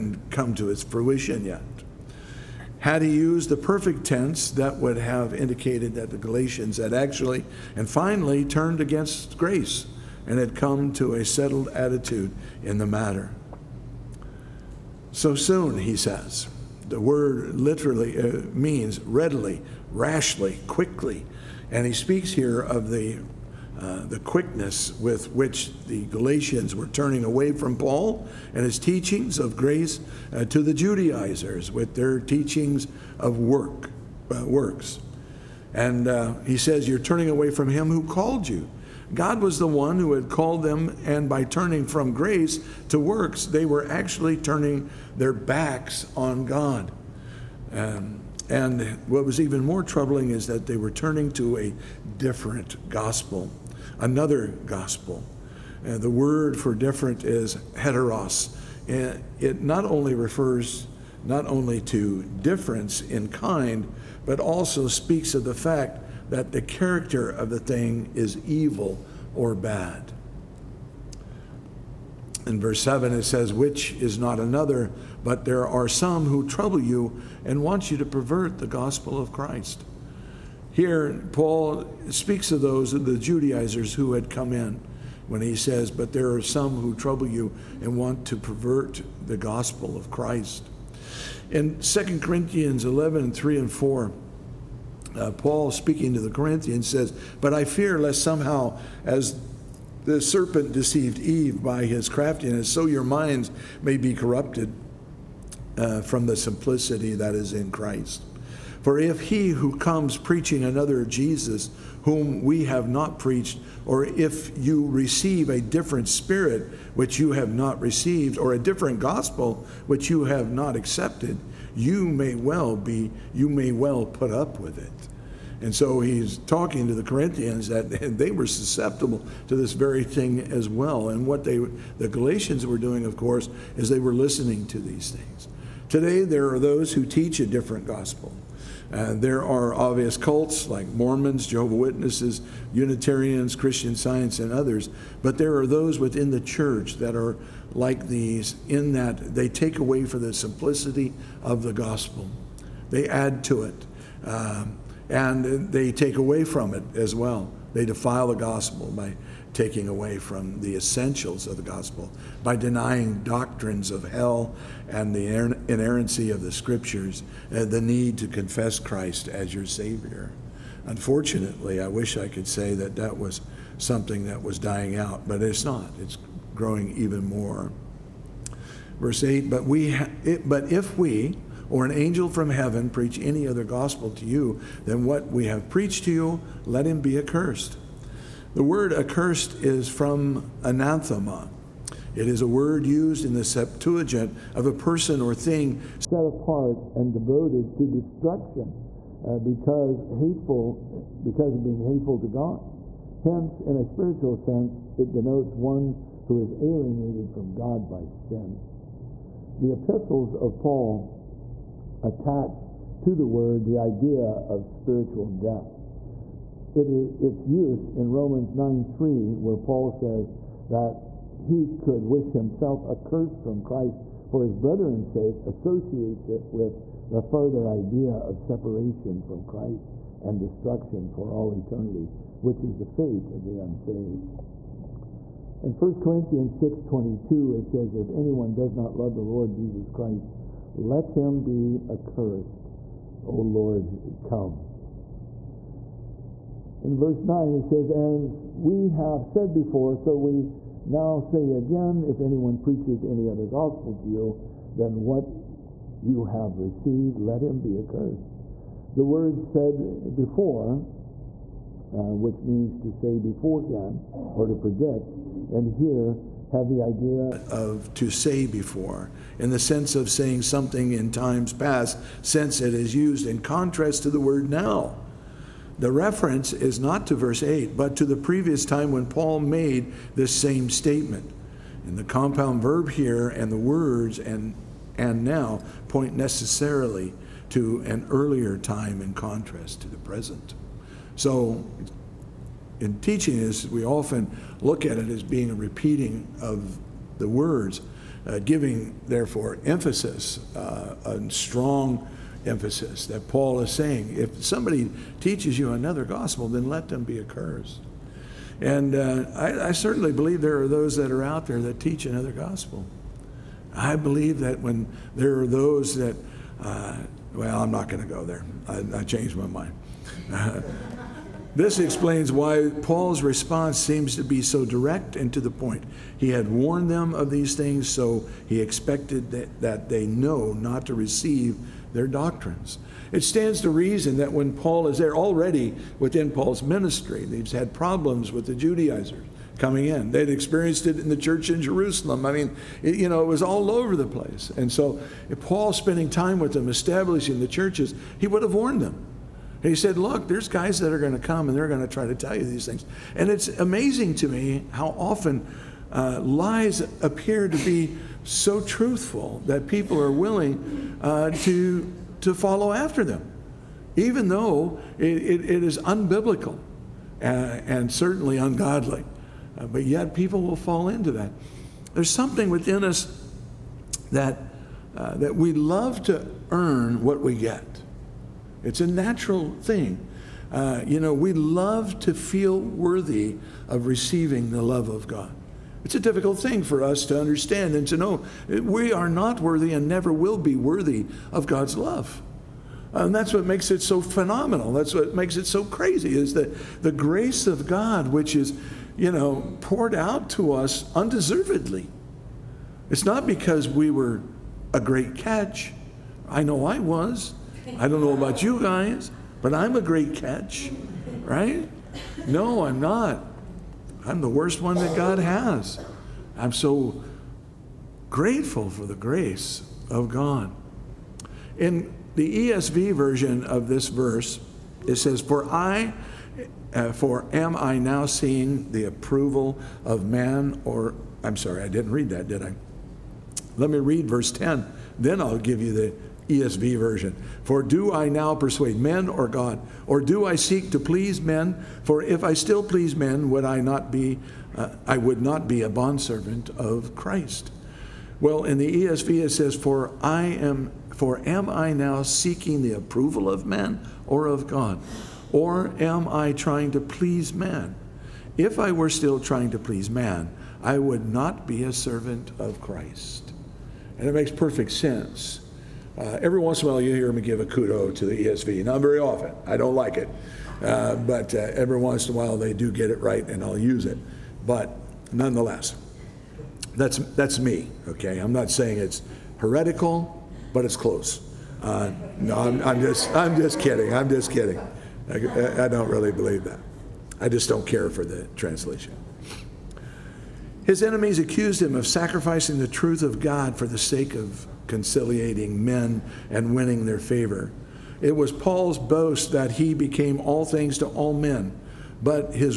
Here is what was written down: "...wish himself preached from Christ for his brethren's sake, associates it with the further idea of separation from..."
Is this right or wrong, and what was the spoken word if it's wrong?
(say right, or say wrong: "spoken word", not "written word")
wrong: "accursed", not "preached".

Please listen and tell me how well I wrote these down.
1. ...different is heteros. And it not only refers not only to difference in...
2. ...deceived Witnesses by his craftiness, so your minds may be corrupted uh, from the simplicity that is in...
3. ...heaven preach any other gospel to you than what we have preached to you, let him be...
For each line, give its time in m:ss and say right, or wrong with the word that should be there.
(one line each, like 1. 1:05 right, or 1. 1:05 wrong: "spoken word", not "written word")
1. 0:56 right
2. 1:40 wrong: "Eve", not "Witnesses"
3. 3:02 right.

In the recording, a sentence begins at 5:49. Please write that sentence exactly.
he said, Look, there's guys that are going to come and they're going to try to tell you these things.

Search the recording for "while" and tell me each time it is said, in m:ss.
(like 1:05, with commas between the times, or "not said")
7:46, 7:52.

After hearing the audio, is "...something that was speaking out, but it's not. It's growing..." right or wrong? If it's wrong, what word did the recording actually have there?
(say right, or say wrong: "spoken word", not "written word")
wrong: "dying", not "speaking".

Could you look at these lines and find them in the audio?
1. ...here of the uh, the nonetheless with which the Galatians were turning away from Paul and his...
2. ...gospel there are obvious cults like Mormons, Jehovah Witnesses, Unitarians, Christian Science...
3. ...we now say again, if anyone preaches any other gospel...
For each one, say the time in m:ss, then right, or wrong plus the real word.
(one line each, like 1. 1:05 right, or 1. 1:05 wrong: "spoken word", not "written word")
1. 0:22 wrong: "quickness", not "nonetheless"
2. 2:17 right
3. 4:10 right.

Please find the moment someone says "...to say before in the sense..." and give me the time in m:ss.
4:27.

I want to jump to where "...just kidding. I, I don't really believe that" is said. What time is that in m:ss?
8:04.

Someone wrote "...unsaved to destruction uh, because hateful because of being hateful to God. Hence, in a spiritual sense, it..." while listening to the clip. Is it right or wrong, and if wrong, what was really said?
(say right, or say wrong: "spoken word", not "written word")
wrong: "devoted", not "unsaved".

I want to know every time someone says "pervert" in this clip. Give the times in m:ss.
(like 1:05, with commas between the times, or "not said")
1:18, 1:28.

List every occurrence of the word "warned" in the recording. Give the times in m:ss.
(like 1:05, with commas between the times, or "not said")
5:26, 5:48.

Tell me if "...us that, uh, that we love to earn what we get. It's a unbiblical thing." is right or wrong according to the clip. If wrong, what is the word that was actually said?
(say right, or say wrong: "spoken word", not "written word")
wrong: "natural", not "unbiblical".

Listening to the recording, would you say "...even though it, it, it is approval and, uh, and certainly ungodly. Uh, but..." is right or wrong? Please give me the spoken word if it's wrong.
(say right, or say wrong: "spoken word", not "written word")
wrong: "unbiblical", not "approval".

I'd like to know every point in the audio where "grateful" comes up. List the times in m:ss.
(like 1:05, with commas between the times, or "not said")
6:58.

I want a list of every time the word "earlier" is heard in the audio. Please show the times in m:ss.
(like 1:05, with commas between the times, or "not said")
4:48.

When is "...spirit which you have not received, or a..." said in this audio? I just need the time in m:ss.
1:56.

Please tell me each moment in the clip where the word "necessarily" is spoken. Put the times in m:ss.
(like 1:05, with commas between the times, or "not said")
4:46.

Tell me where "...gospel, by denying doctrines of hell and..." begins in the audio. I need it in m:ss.
2:41.